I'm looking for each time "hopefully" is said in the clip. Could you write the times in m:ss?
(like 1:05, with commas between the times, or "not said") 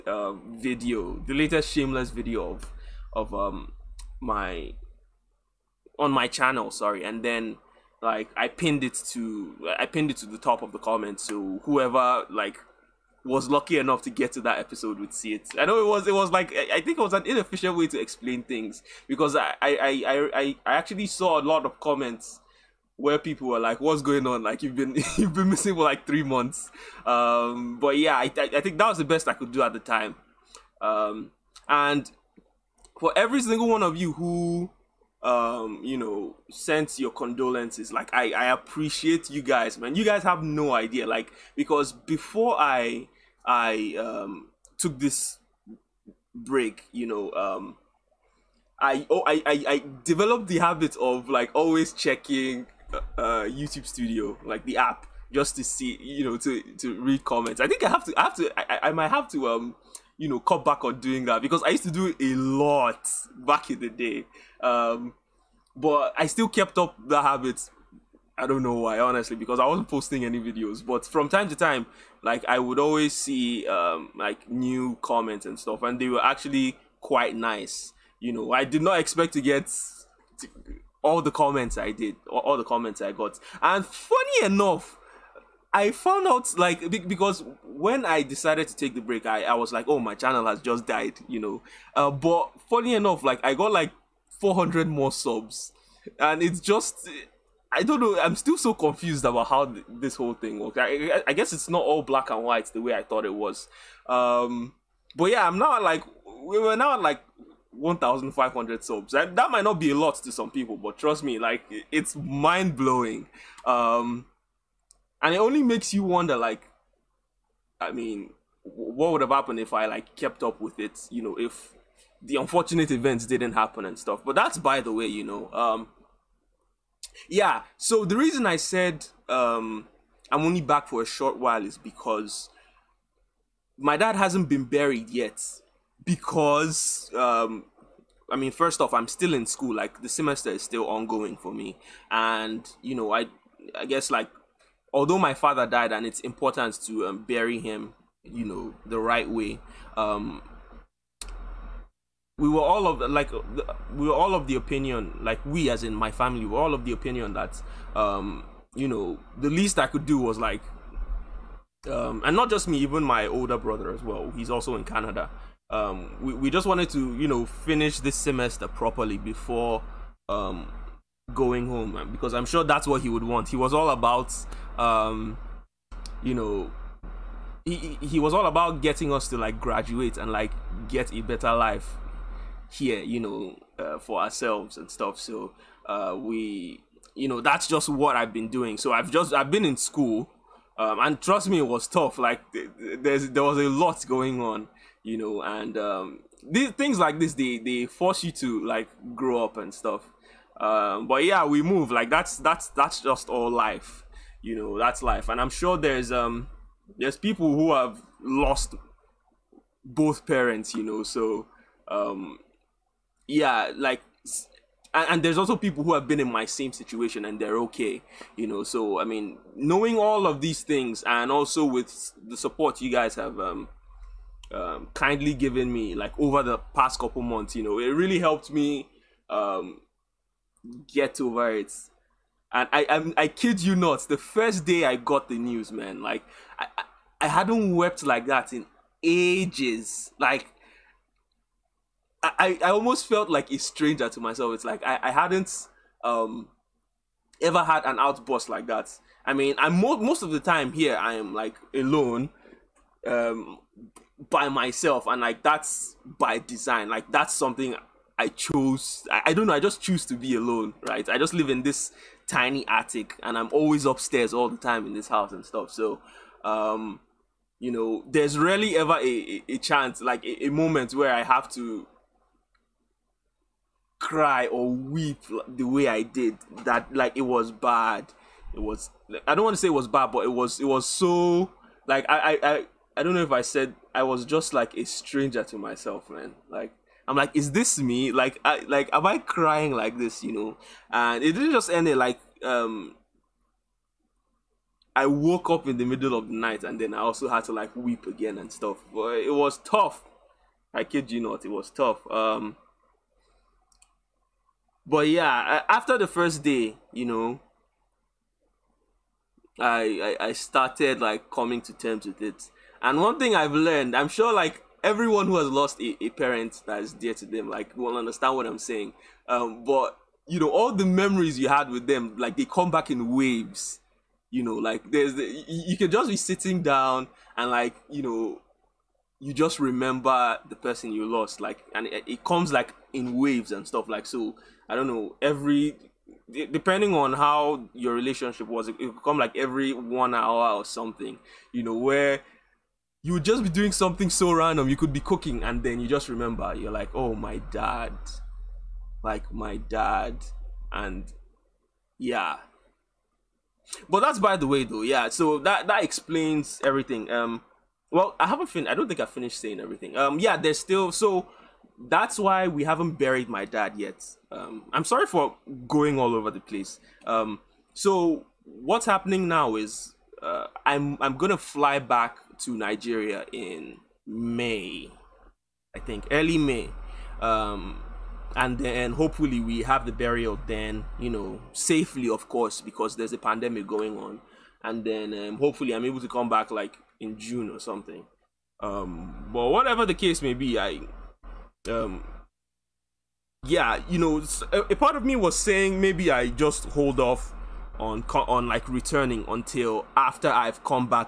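6:18, 6:25.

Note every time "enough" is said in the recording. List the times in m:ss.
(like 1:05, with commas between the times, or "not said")
0:13, 1:24, 1:32.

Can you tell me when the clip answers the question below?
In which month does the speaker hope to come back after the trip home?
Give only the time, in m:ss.
6:27.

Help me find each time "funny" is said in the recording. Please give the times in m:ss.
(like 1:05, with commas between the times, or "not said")
1:23, 1:32.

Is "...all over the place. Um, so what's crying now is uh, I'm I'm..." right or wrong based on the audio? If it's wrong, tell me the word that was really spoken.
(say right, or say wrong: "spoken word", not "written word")
wrong: "happening", not "crying".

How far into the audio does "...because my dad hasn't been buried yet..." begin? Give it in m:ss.
2:11.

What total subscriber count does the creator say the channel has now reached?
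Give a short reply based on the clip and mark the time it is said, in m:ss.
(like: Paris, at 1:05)
1,500, at 1:47.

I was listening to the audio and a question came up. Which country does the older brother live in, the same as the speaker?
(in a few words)
Canada.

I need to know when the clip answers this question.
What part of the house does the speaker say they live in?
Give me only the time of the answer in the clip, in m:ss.
4:22.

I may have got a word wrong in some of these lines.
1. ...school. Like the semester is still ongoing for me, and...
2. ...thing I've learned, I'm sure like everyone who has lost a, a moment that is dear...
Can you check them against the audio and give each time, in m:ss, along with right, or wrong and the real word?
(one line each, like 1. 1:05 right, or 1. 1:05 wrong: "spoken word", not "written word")
1. 2:19 right
2. 5:13 wrong: "parent", not "moment".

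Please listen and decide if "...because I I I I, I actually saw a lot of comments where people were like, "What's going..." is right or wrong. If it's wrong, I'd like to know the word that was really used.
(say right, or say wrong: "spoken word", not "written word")
right.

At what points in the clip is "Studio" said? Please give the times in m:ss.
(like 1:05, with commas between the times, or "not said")
0:53.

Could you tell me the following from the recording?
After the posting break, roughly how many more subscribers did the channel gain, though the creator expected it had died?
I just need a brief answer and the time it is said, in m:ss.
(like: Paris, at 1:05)
400, at 1:34.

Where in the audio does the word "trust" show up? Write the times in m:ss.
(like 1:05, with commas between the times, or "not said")
1:50, 3:11.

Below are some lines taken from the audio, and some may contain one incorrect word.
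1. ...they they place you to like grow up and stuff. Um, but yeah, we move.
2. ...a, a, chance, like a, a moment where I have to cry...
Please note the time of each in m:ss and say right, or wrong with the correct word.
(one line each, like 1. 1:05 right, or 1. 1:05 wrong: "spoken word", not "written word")
1. 3:17 wrong: "force", not "place"
2. 4:29 right.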